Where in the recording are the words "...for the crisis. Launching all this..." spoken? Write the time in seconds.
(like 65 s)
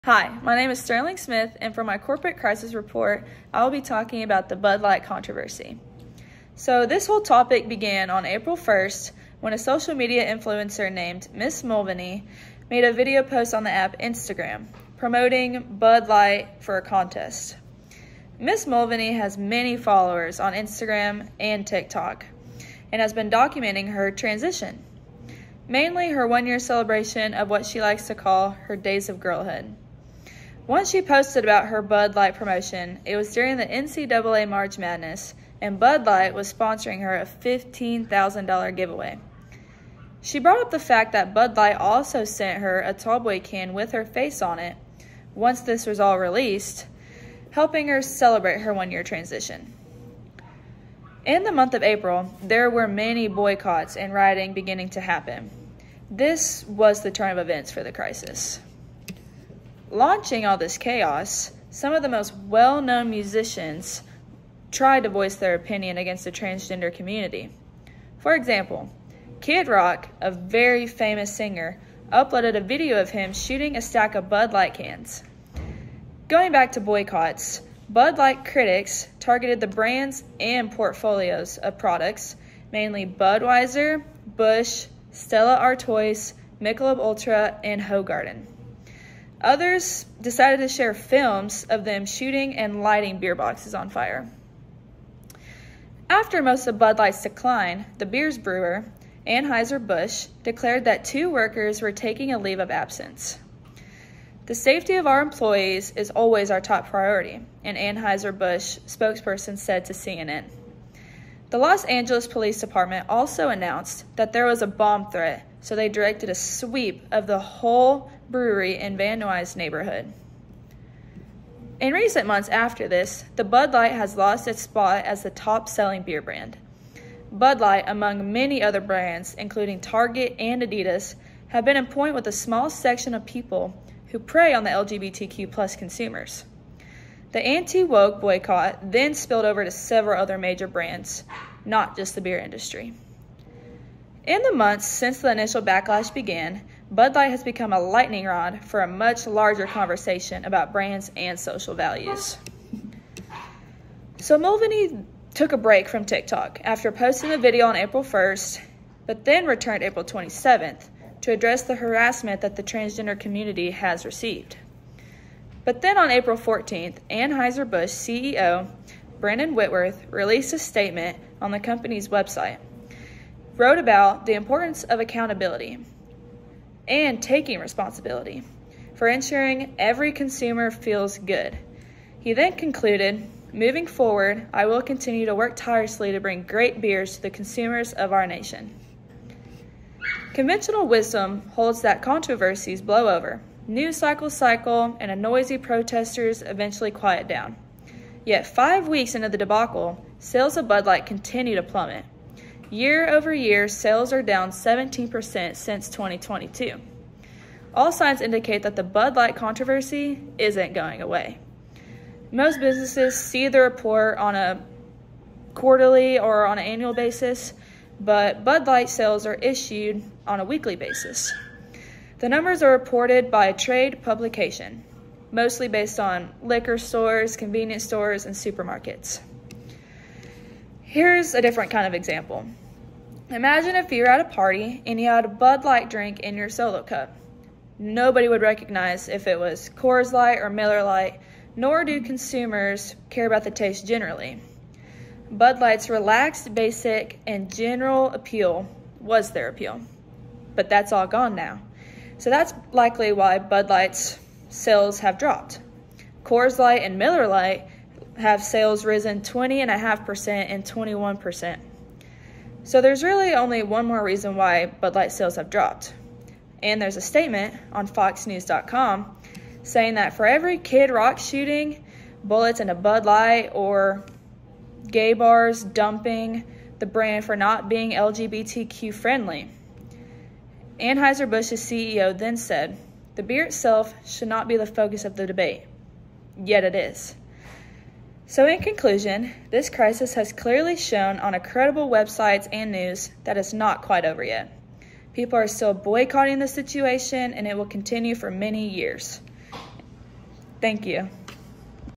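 57 s.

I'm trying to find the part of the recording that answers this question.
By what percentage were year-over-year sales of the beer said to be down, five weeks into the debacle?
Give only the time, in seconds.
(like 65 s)
204 s.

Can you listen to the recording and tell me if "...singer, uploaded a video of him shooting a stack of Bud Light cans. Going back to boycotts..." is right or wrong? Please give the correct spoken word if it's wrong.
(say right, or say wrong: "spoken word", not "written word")
right.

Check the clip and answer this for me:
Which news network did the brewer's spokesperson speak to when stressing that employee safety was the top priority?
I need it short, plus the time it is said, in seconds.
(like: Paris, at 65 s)
CNN, at 109 s.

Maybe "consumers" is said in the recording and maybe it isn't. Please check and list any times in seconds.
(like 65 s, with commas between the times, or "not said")
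135 s, 180 s, 187 s, 242 s.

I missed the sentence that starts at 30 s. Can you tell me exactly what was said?
Once she posted about her Bud Light promotion.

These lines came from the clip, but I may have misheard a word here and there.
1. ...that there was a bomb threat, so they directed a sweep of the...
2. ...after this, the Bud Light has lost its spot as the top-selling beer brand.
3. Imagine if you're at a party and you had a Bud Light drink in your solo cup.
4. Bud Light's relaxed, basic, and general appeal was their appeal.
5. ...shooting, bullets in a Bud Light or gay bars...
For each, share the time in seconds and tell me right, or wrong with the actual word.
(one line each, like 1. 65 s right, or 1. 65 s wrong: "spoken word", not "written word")
1. 114 s right
2. 122 s right
3. 233 s right
4. 245 s right
5. 271 s right.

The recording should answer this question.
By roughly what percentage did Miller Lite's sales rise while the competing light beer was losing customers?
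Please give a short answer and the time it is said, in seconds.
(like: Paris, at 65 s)
21%, at 260 s.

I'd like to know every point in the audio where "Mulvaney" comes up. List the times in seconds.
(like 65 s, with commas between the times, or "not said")
11 s, 18 s, 154 s.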